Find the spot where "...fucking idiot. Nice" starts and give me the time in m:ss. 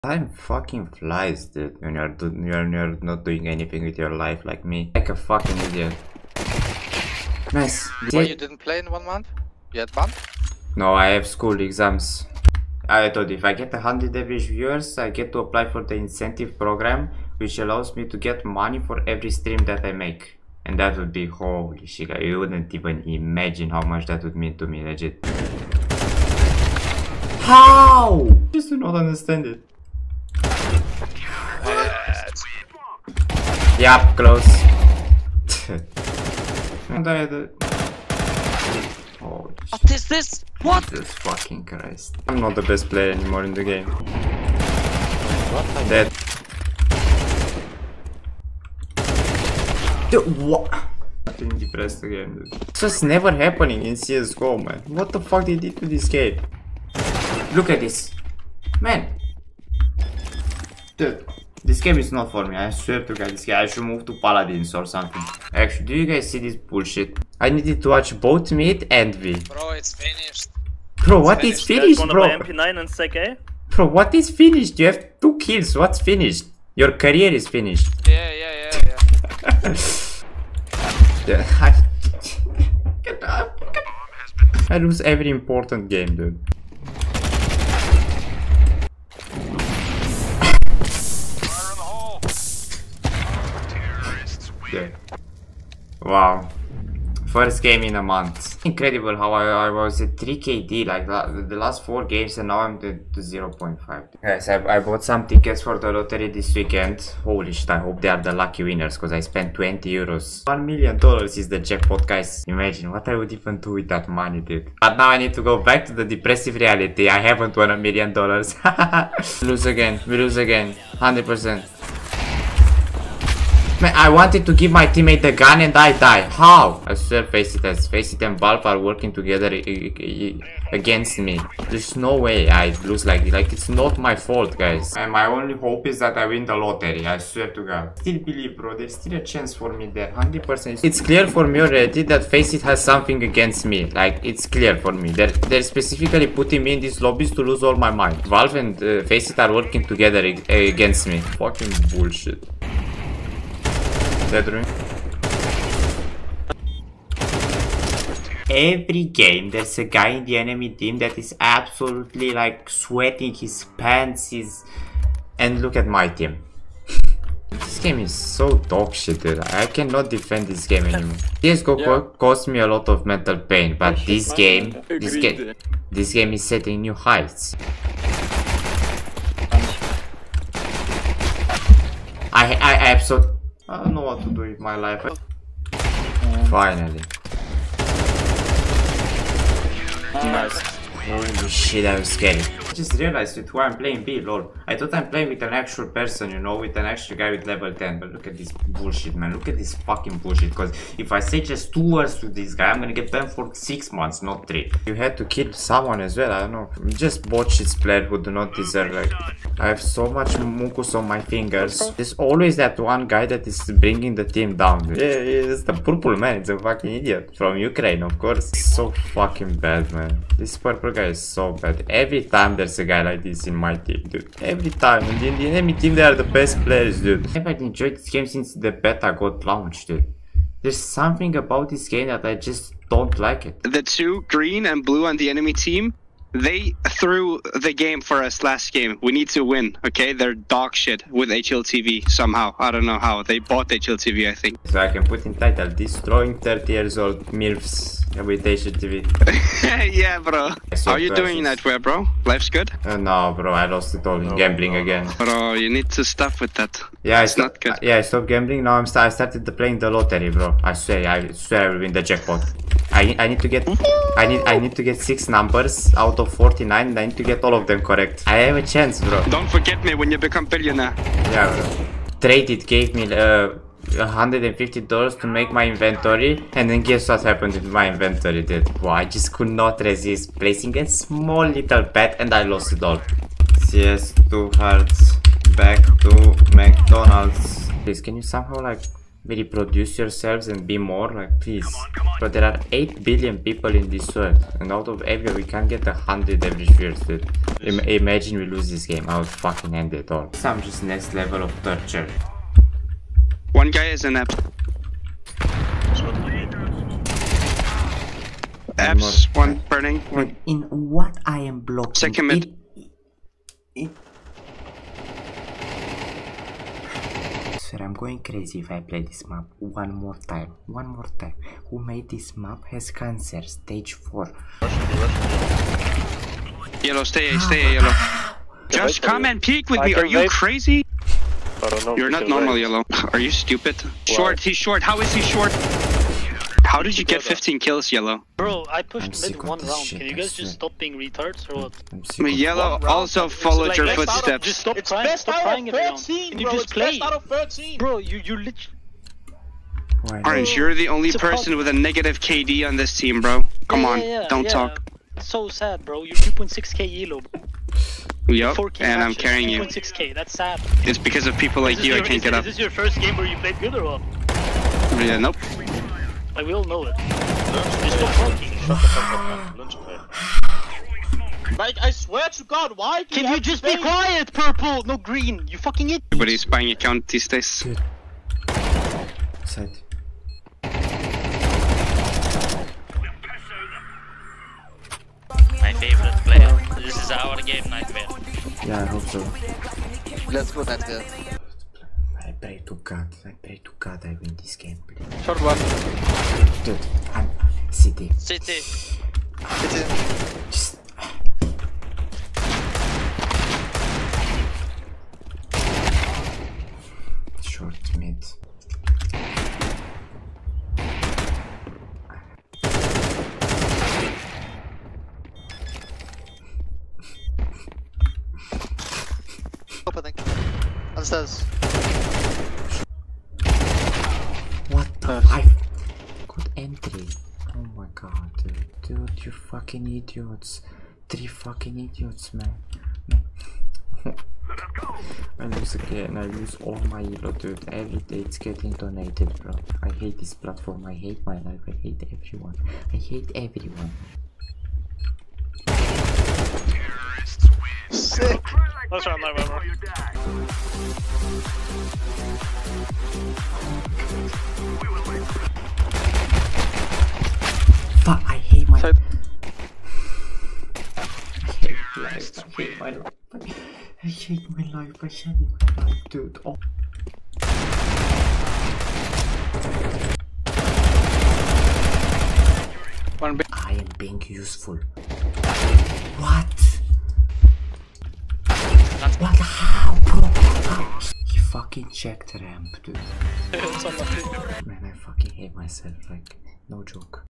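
0:05.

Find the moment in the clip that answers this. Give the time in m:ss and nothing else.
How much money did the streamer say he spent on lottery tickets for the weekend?
1:49.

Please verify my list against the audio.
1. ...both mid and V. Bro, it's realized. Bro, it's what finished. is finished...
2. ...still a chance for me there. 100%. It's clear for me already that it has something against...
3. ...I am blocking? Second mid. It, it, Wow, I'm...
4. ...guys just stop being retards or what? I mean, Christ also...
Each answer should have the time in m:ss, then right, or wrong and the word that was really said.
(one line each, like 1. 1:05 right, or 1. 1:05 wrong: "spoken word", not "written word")
1. 1:08 wrong: "finished", not "realized"
2. 2:18 right
3. 5:11 wrong: "Sir", not "Wow"
4. 5:40 wrong: "Yellow", not "Christ".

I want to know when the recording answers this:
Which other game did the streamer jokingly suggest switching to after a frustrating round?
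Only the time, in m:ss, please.
1:04.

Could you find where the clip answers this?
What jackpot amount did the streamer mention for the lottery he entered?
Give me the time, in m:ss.
1:50.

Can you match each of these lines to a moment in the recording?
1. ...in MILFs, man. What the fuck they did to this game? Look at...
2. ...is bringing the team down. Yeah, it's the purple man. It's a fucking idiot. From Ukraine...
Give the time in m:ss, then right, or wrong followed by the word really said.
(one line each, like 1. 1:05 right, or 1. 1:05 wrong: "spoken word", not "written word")
1. 0:53 wrong: "CSGO", not "MILFs"
2. 3:33 right.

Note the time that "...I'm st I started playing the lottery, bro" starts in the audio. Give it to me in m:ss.
4:18.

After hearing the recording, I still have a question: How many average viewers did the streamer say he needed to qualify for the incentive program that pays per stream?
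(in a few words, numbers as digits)
100.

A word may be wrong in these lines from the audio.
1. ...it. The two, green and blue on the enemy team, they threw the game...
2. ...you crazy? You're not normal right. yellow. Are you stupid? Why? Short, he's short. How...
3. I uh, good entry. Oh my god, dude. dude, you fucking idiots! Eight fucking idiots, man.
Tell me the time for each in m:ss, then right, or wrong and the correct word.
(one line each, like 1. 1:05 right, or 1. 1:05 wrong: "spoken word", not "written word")
1. 3:53 right
2. 5:30 right
3. 7:05 wrong: "Three", not "Eight".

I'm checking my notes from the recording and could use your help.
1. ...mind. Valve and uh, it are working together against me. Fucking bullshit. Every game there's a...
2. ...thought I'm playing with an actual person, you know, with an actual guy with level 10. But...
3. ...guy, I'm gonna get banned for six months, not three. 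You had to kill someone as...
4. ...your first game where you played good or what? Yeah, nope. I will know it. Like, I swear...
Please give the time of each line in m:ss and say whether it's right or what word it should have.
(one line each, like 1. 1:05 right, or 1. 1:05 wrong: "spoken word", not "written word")
1. 2:27 right
2. 3:14 right
3. 3:22 right
4. 6:02 right.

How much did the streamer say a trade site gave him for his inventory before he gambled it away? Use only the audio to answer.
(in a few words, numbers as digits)
$150.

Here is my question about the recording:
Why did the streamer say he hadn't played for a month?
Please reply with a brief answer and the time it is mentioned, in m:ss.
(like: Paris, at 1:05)
School exams, at 0:11.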